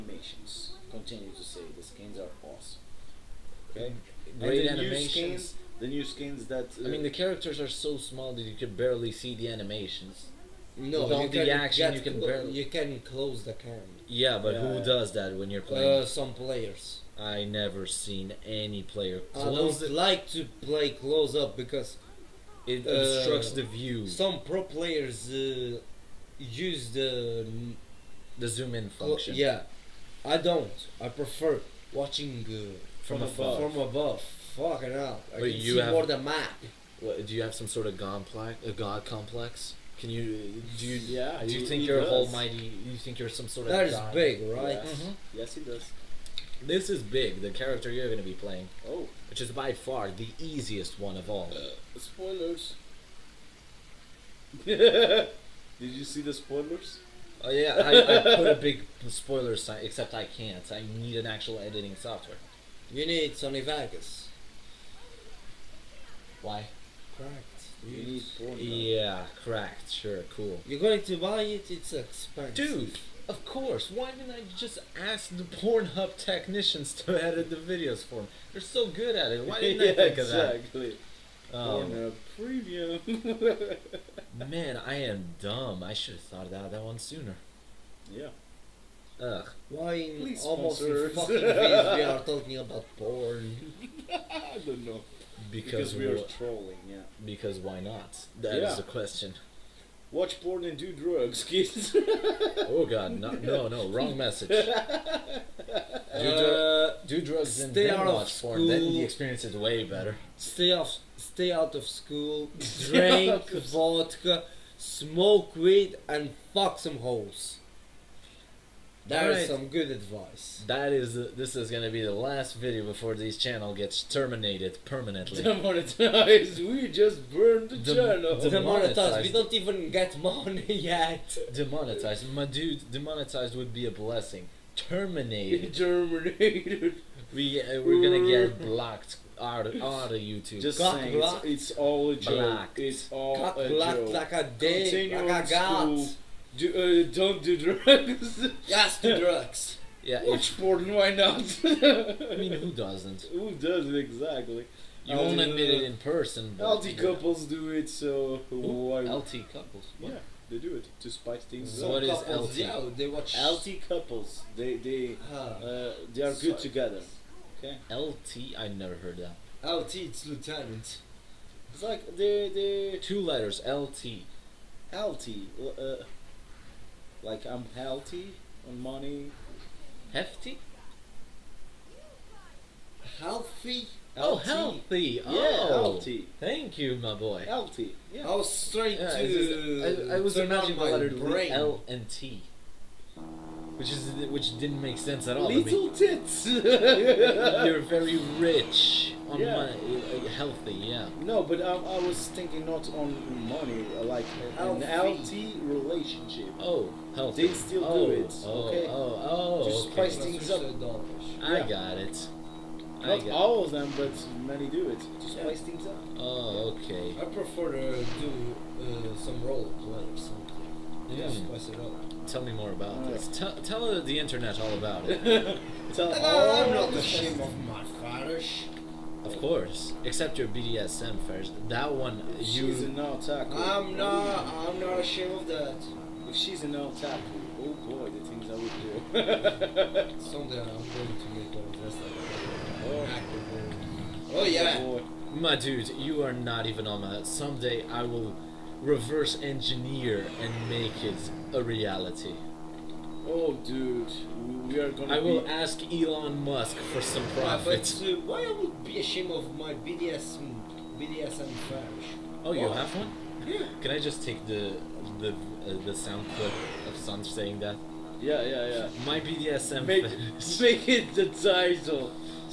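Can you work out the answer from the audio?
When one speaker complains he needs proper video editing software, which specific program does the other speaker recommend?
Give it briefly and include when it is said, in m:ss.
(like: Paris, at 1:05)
Sony Vegas, at 1:03.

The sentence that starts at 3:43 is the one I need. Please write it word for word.
Tell Tell, the internet all about it.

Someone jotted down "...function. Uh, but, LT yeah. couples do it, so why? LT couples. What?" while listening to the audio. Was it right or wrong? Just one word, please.
wrong.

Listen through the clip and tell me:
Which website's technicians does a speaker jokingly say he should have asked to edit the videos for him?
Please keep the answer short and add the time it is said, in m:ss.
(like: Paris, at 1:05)
Pornhub, at 1:15.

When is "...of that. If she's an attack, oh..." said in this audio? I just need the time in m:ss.
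3:55.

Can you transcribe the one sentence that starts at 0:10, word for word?
No, all the action, you can barely.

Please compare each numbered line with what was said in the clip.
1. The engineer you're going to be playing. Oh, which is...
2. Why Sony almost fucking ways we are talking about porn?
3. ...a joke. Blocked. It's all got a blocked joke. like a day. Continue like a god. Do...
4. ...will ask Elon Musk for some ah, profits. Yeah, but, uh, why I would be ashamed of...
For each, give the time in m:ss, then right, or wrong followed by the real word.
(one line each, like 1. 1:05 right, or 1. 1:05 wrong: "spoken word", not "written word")
1. 0:47 wrong: "character", not "engineer"
2. 1:29 wrong: "Please", not "Sony"
3. 2:22 right
4. 4:15 right.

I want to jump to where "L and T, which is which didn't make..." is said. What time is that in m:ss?
3:11.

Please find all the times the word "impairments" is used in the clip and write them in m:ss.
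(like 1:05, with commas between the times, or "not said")
not said.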